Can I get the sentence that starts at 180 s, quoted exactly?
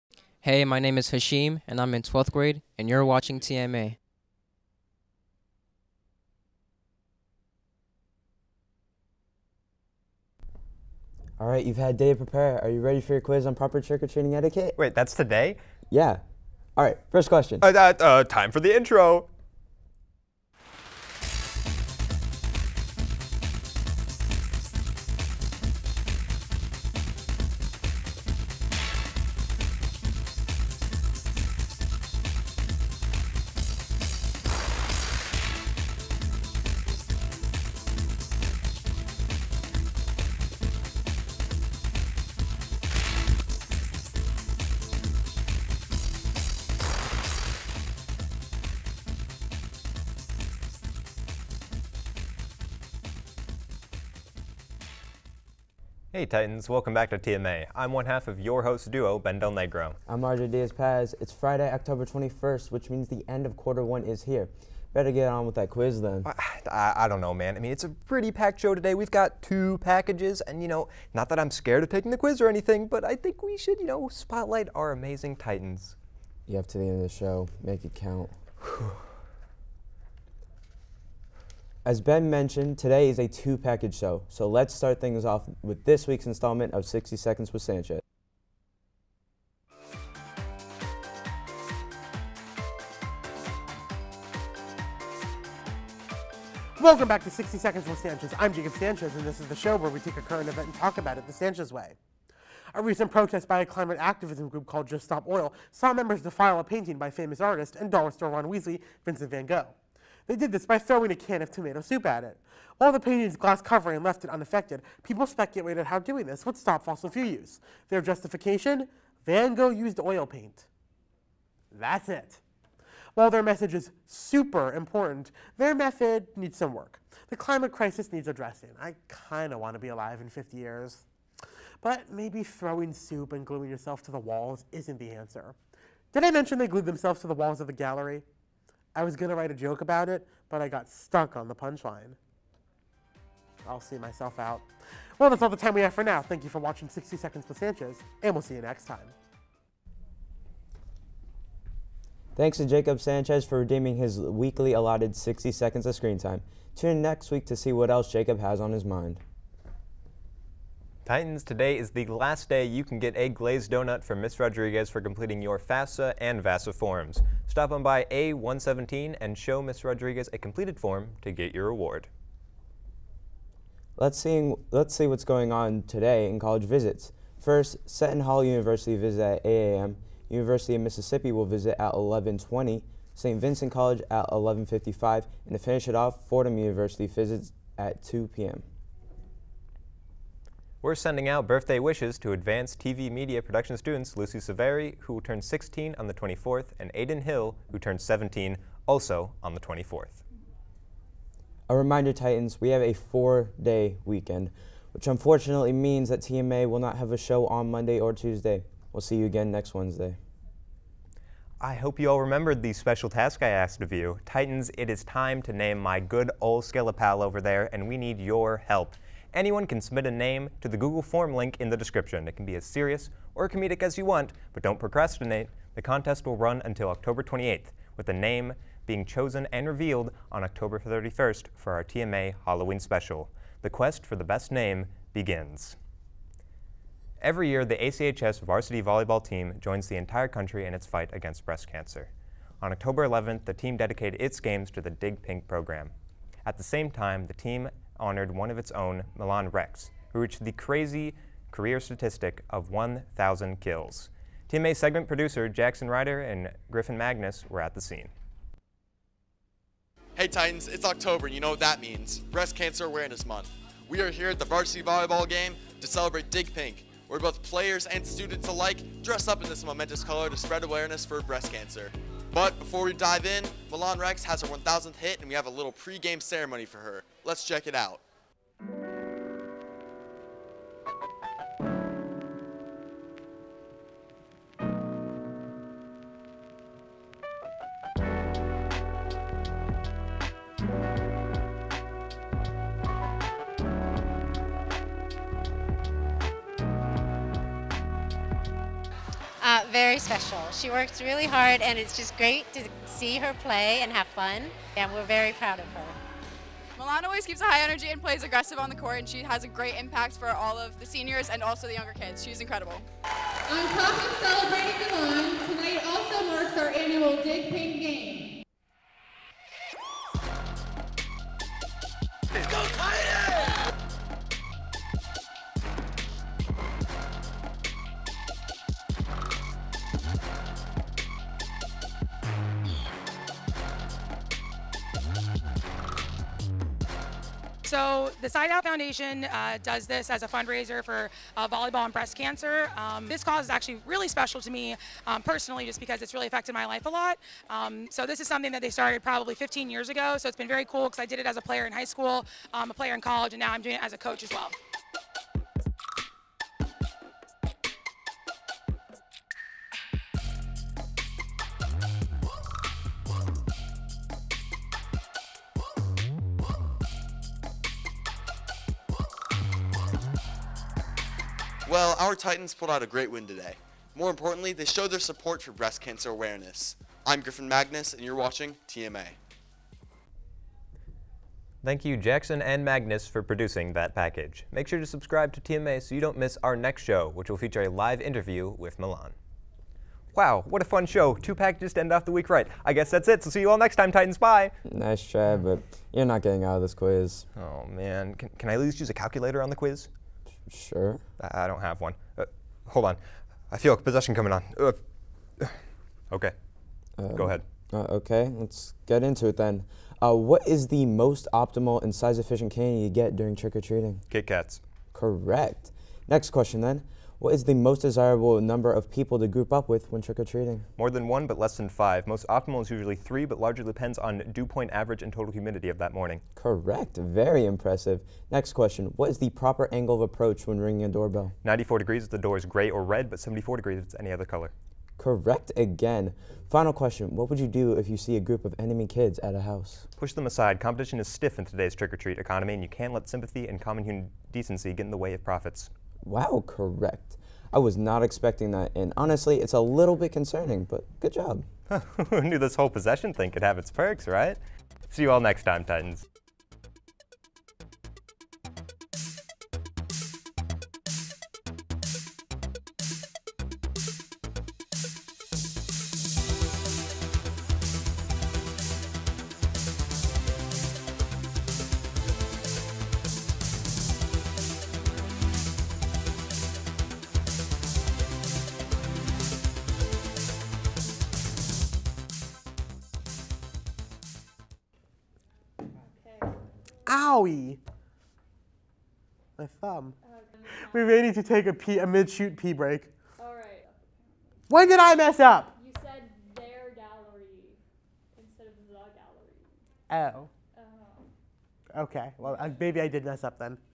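University of Mississippi will visit at 1120, St.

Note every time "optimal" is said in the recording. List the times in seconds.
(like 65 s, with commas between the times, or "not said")
411 s, 422 s.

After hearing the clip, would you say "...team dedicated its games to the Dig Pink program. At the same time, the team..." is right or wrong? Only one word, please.
right.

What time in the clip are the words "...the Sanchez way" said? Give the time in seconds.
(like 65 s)
101 s.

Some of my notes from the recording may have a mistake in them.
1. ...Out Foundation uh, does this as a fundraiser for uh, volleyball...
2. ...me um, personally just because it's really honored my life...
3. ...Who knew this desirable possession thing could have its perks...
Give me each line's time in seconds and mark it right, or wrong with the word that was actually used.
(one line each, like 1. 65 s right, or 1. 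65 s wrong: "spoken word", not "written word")
1. 338 s right
2. 344 s wrong: "affected", not "honored"
3. 452 s wrong: "whole", not "desirable".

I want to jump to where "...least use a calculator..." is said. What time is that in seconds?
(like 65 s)
398 s.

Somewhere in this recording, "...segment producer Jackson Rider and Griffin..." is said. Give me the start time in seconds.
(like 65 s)
254 s.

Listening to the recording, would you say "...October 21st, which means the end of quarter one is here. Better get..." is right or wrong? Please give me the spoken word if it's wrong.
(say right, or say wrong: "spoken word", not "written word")
right.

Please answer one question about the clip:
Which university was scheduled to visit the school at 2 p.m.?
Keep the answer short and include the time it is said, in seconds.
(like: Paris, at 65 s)
Fordham University, at 186 s.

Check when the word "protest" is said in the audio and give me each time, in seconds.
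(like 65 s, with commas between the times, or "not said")
103 s.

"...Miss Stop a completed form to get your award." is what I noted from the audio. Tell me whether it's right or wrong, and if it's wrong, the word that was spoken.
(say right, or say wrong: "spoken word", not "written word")
wrong: "Rodriguez", not "Stop".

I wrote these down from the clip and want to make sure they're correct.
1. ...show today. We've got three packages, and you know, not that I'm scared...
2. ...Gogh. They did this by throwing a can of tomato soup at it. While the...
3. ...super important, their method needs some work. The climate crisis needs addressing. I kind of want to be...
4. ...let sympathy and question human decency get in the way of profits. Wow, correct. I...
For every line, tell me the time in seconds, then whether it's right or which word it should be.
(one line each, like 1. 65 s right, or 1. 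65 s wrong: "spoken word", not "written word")
1. 68 s wrong: "two", not "three"
2. 109 s right
3. 124 s right
4. 442 s wrong: "common", not "question".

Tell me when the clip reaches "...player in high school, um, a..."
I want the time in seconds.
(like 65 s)
351 s.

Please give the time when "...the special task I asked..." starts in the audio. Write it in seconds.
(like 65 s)
212 s.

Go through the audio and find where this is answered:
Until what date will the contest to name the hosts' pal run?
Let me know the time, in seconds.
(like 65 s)
226 s.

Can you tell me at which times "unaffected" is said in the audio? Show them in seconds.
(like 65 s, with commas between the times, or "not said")
114 s.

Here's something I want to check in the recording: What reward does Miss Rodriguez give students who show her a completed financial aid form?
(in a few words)
A glazed donut.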